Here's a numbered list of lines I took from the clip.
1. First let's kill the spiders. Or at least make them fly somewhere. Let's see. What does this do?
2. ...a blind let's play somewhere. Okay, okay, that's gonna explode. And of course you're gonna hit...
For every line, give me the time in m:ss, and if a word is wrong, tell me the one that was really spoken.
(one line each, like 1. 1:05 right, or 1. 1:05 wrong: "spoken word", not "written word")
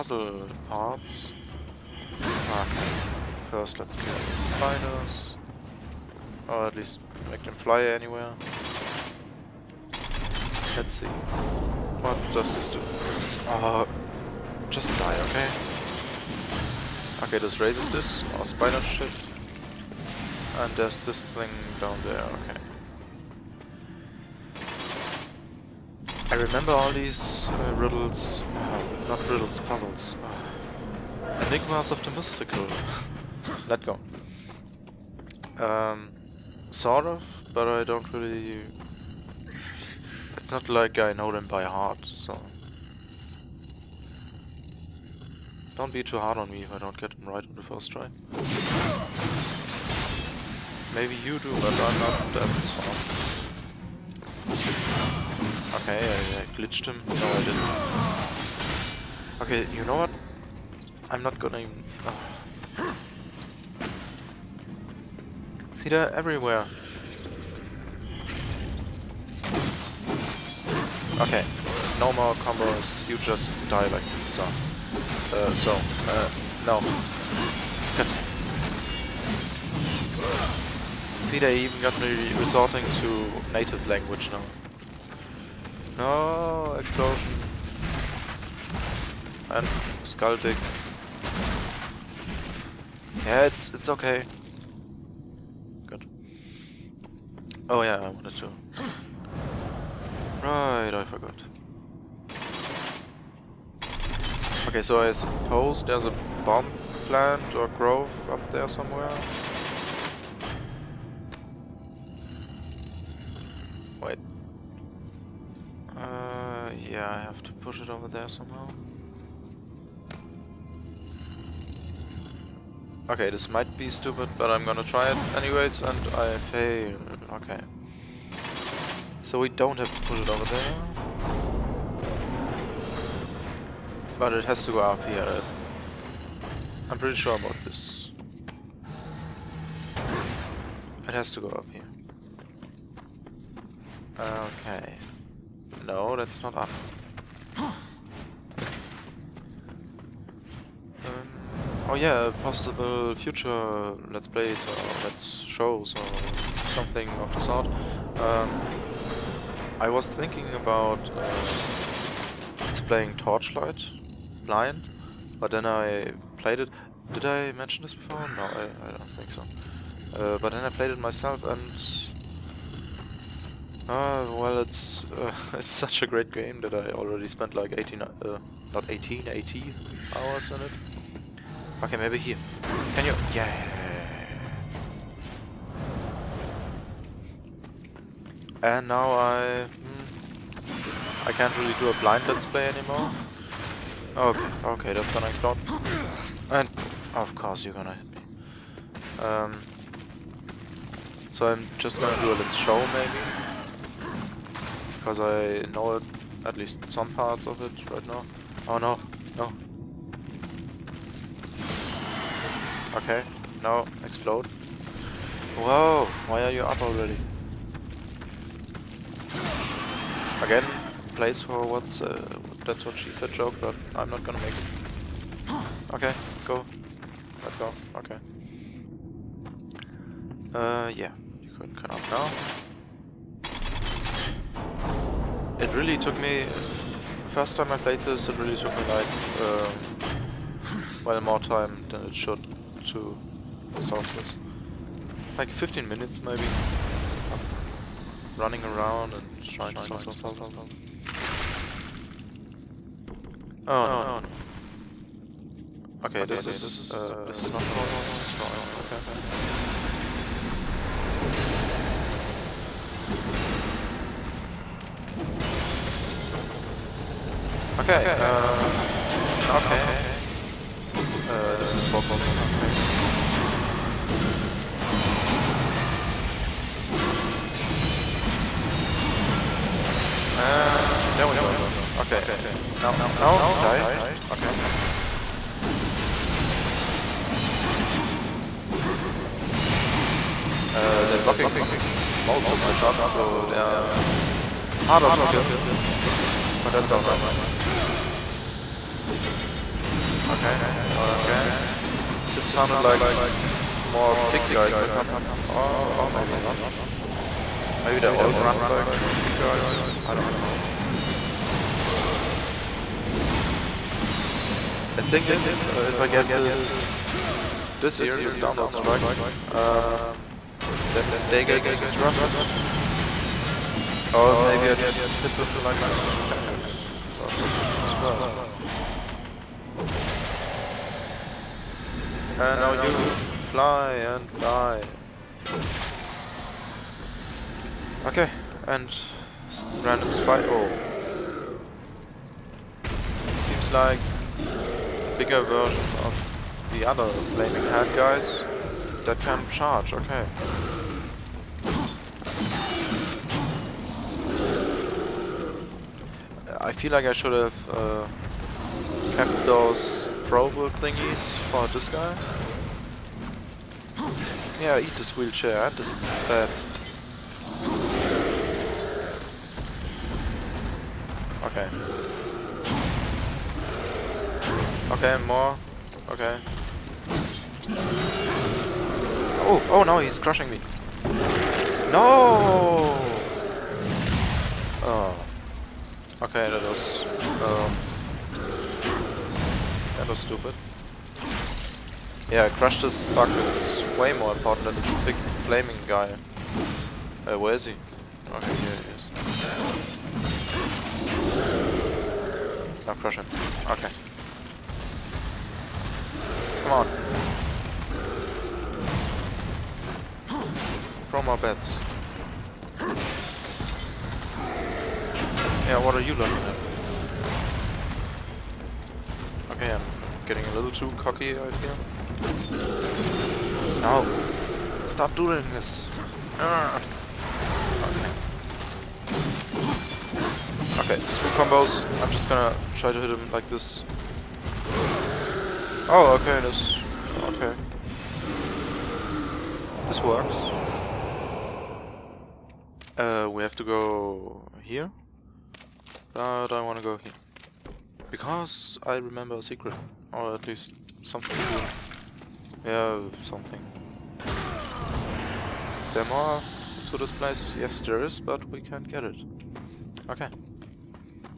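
1. 0:03 wrong: "anywhere", not "somewhere"
2. 3:11 wrong: "anymore", not "somewhere".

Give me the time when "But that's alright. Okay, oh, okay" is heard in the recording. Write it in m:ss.
4:56.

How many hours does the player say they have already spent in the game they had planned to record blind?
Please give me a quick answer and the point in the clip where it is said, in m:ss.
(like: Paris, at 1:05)
80, at 2:59.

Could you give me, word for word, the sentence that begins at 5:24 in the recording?
Or maybe I just hit them like this.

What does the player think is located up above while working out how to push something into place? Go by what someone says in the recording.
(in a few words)
bomb plant.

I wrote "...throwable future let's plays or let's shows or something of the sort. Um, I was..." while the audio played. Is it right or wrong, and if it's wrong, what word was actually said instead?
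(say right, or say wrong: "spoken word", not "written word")
wrong: "possible", not "throwable".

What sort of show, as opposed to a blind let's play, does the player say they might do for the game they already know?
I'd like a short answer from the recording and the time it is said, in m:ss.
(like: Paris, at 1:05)
let's show, at 3:22.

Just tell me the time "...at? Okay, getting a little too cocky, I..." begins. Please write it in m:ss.
6:59.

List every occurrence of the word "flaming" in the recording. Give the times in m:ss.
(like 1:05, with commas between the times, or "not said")
5:47, 6:35.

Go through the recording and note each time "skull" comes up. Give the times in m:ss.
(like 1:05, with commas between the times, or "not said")
1:30.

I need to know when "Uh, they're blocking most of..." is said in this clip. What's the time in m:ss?
4:50.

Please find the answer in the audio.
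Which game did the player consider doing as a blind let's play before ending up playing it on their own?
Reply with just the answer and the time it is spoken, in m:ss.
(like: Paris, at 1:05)
Torchlight, at 2:43.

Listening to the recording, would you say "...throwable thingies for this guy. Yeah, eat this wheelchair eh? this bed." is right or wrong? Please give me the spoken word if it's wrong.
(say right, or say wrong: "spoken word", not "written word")
right.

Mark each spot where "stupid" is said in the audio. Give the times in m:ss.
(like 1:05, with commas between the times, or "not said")
2:03, 6:30.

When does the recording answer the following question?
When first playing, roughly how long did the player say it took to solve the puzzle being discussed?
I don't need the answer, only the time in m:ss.
4:05.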